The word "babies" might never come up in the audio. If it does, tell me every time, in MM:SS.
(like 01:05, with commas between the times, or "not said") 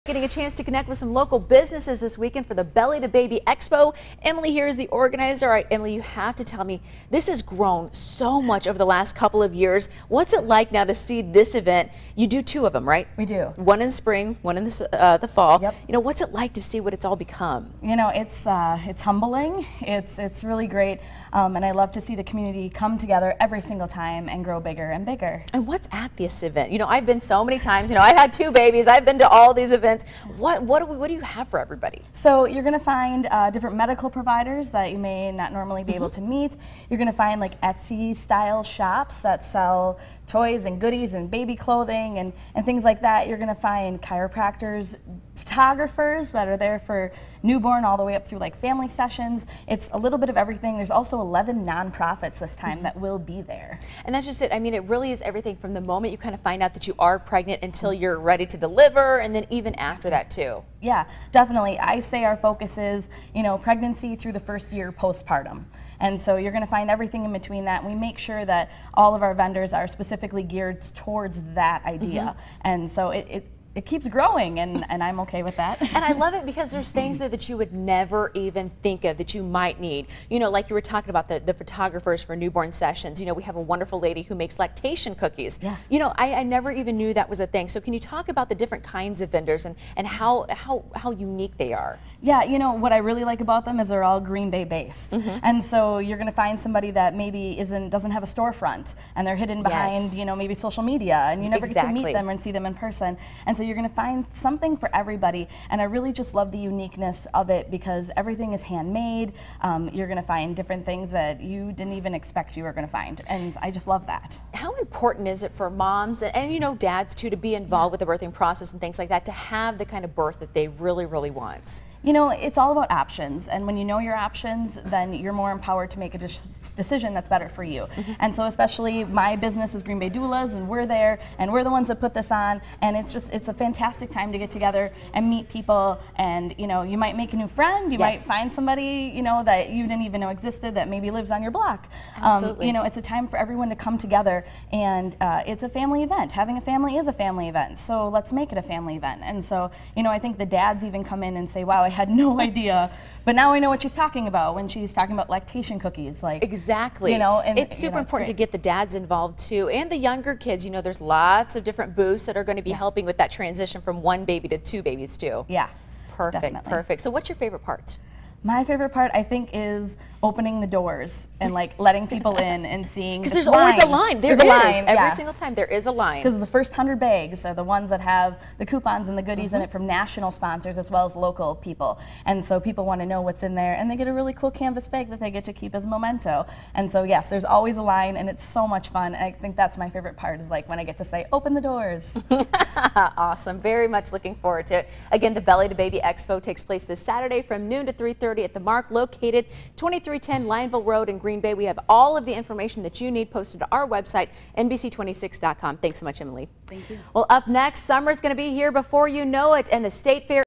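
00:28, 02:44.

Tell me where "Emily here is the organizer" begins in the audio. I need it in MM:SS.
00:04.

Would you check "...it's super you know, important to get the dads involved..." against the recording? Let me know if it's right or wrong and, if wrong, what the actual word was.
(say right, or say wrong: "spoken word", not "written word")
right.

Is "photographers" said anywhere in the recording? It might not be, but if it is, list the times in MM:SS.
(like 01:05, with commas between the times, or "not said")
00:45, 01:21.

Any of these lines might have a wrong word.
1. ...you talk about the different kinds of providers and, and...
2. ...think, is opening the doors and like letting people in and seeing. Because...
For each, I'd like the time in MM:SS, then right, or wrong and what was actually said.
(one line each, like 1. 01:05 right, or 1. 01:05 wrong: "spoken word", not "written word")
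1. 01:27 wrong: "vendors", not "providers"
2. 02:49 right.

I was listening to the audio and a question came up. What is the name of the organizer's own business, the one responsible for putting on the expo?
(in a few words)
Green Bay Doulas.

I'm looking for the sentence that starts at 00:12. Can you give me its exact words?
You do two of them, right?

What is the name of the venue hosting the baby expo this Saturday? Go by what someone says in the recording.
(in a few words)
the Marq.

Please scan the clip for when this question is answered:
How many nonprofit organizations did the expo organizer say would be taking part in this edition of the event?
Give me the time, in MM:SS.
00:51.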